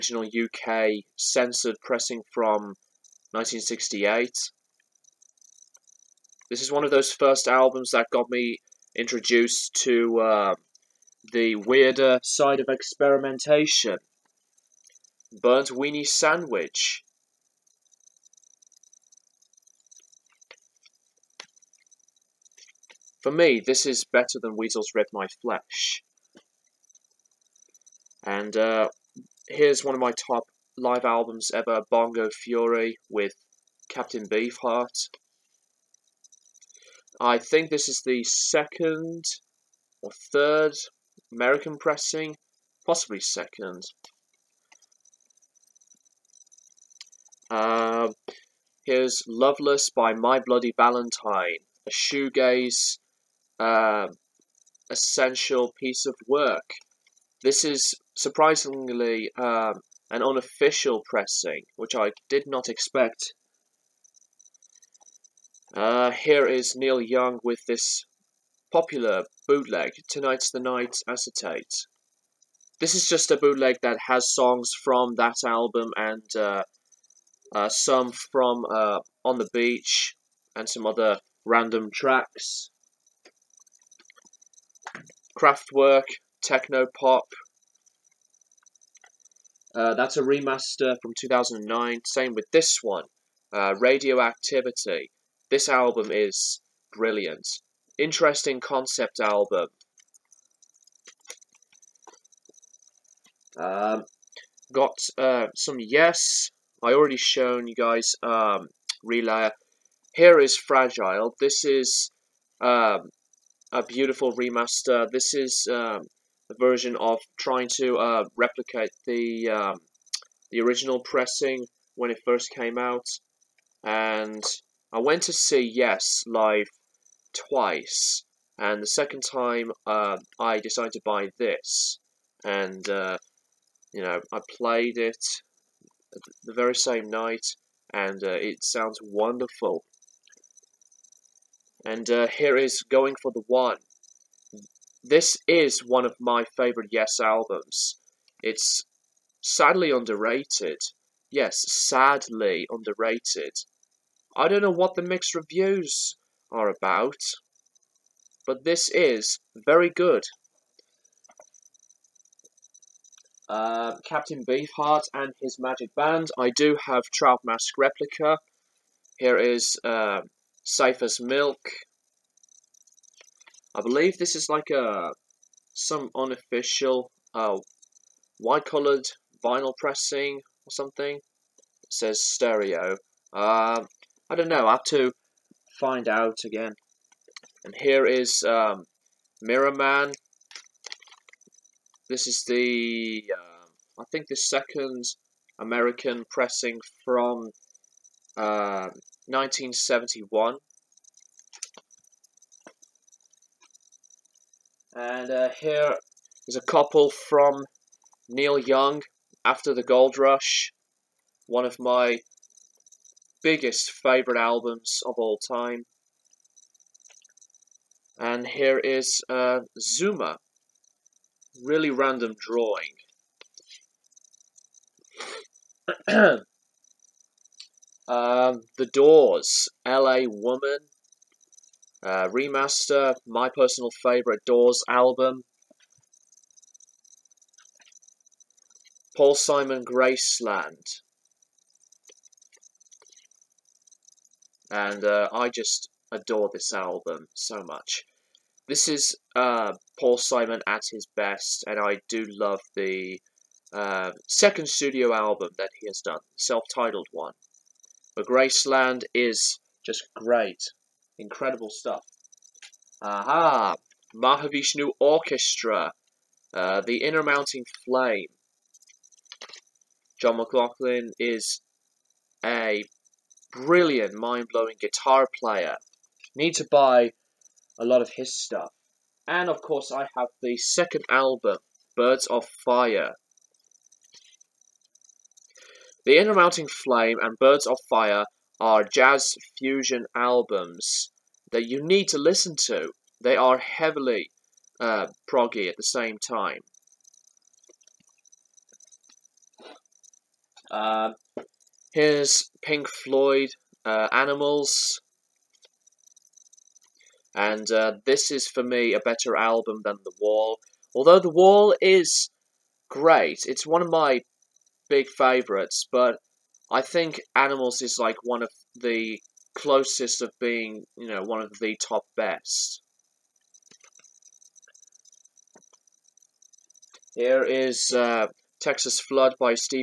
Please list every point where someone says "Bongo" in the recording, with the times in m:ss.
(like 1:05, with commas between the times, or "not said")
0:31.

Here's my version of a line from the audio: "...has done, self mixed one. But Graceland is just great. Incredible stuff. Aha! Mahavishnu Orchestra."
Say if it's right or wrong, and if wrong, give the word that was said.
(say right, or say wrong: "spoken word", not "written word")
wrong: "titled", not "mixed".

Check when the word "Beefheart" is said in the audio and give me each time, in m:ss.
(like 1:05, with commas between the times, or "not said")
0:34, 2:44.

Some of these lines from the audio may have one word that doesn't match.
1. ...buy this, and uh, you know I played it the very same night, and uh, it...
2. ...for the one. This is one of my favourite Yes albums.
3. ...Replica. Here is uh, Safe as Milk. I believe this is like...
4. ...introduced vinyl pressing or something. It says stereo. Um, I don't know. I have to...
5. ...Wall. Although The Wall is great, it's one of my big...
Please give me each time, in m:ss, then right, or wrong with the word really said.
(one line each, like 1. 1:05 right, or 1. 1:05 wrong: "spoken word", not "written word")
1. 2:11 right
2. 2:23 right
3. 2:47 right
4. 2:58 wrong: "colored", not "introduced"
5. 5:10 right.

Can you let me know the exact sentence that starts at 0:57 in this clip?
This is surprisingly um, an unofficial pressing, which I did not expect.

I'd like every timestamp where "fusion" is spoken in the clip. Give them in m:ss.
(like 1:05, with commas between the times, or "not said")
4:49.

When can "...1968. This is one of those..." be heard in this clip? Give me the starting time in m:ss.
0:03.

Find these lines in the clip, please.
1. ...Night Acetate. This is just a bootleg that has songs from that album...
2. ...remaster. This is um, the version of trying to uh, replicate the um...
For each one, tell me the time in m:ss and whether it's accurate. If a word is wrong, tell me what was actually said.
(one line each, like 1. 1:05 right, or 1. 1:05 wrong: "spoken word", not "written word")
1. 1:10 right
2. 1:54 right.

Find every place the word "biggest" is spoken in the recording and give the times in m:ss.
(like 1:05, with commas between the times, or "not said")
3:33.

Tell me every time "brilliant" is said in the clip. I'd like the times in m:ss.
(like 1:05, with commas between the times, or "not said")
1:36, 4:33.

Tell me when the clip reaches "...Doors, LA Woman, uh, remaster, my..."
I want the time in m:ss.
3:48.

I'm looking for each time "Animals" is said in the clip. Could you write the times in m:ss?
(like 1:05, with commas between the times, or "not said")
5:04, 5:17.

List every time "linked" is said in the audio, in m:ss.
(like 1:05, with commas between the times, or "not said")
not said.